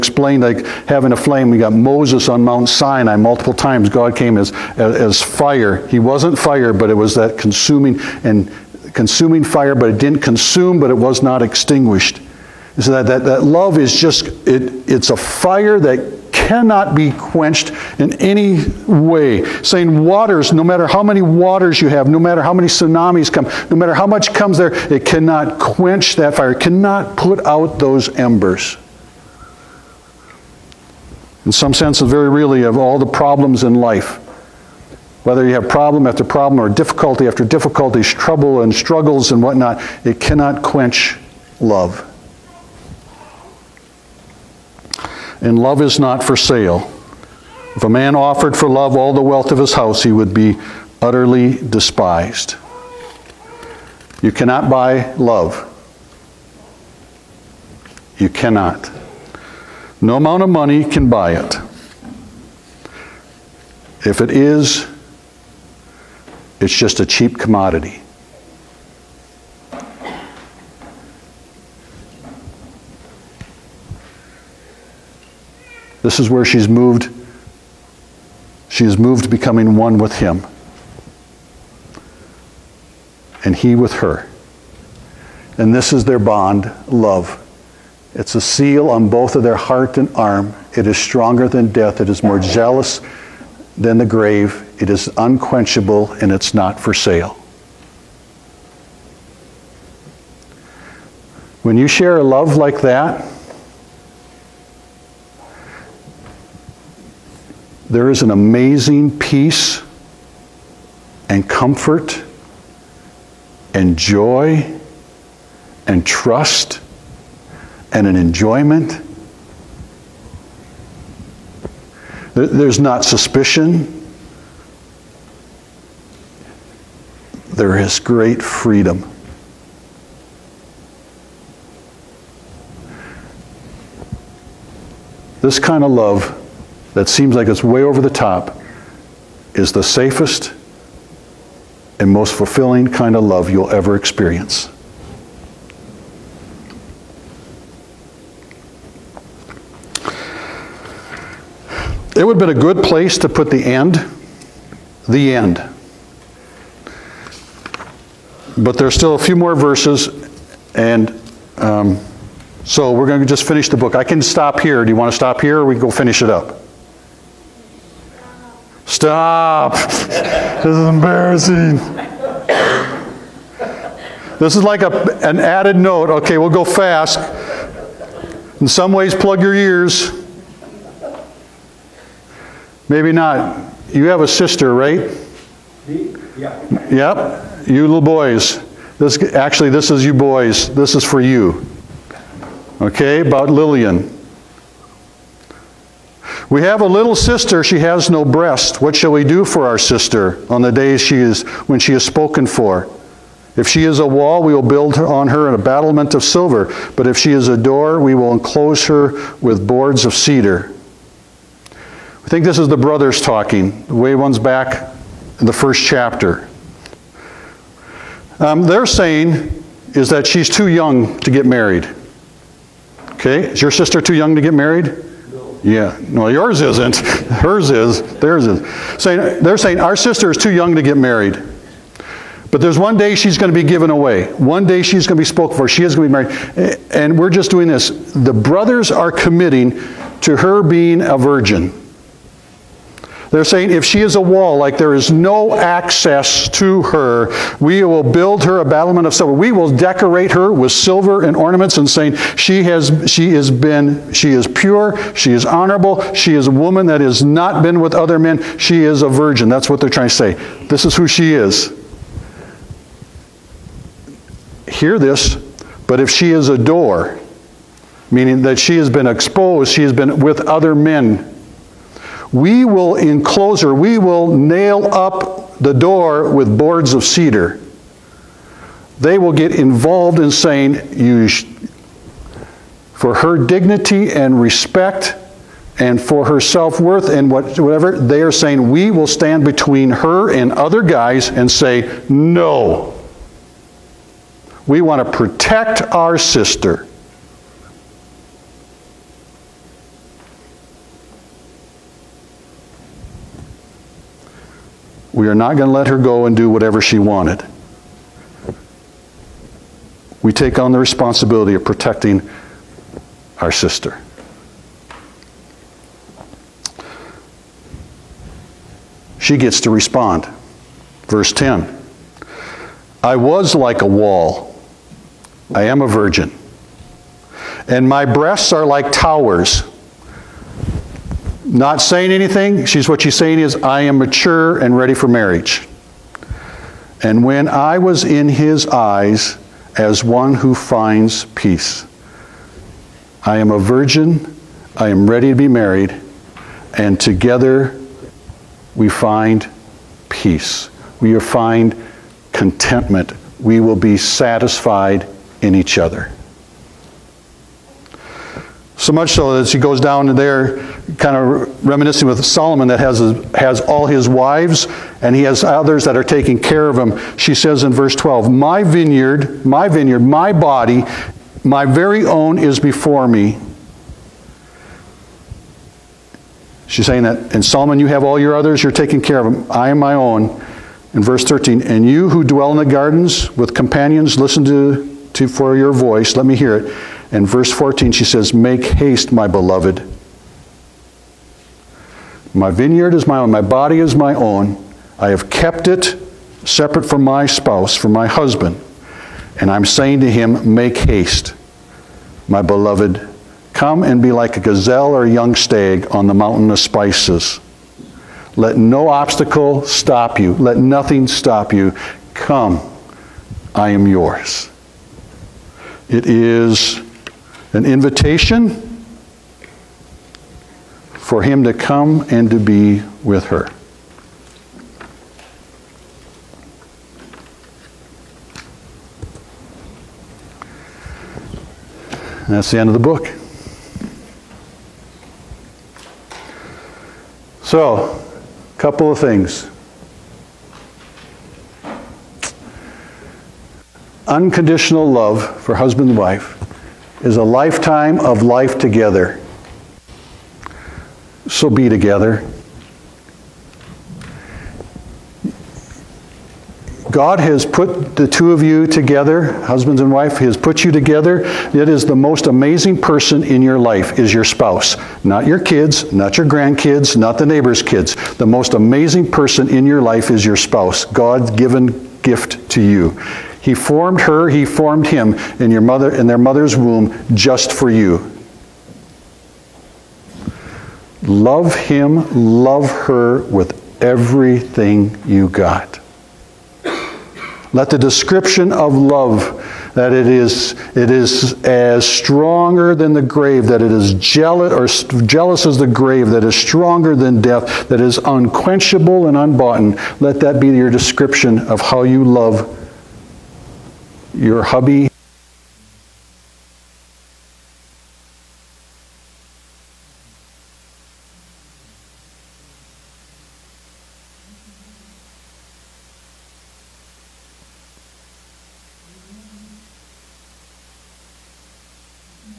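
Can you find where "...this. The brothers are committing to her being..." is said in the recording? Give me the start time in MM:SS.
03:57.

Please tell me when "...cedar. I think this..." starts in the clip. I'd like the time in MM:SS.
03:30.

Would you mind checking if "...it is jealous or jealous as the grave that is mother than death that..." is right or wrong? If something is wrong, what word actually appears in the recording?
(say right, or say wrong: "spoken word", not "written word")
wrong: "stronger", not "mother".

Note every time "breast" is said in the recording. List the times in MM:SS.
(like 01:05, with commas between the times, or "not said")
03:18, 05:28.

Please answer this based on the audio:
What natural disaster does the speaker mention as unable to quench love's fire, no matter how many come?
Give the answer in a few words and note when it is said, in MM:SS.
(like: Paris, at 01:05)
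Tsunamis, at 00:22.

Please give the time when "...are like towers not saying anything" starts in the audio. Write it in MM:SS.
05:28.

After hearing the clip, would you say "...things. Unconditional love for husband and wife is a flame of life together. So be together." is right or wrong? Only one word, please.
wrong.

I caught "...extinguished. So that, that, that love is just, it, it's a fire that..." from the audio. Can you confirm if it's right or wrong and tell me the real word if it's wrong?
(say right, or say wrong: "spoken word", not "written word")
right.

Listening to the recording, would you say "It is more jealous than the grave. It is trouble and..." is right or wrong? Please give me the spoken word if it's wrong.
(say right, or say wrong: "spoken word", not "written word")
wrong: "unquenchable", not "trouble".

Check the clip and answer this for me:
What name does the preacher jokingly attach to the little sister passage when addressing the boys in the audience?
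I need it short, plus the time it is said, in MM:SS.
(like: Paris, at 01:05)
Lillian, at 03:13.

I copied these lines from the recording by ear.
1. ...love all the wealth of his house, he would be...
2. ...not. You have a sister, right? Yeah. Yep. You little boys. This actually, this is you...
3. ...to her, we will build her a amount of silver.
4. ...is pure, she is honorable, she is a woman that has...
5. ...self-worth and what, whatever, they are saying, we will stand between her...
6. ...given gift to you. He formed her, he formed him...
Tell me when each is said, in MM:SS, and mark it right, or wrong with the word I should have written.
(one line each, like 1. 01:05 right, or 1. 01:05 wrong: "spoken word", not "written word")
1. 00:48 right
2. 03:03 right
3. 04:06 wrong: "battlement", not "amount"
4. 04:14 right
5. 04:46 right
6. 07:51 right.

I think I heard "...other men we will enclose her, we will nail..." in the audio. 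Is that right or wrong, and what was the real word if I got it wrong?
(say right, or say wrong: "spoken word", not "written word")
right.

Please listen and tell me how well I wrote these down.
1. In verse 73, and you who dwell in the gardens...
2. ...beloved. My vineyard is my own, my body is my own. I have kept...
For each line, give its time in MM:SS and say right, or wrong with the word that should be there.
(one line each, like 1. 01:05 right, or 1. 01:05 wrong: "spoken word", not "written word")
1. 06:20 wrong: "13", not "73"
2. 06:29 right.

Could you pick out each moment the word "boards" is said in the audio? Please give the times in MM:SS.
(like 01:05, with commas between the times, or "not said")
03:29, 04:36.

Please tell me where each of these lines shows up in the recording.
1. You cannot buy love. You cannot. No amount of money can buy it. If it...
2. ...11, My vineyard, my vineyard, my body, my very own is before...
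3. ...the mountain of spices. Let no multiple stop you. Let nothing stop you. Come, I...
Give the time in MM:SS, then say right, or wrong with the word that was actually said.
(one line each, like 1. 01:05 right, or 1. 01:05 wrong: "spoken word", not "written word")
1. 00:54 right
2. 06:07 wrong: "12", not "11"
3. 06:46 wrong: "obstacle", not "multiple".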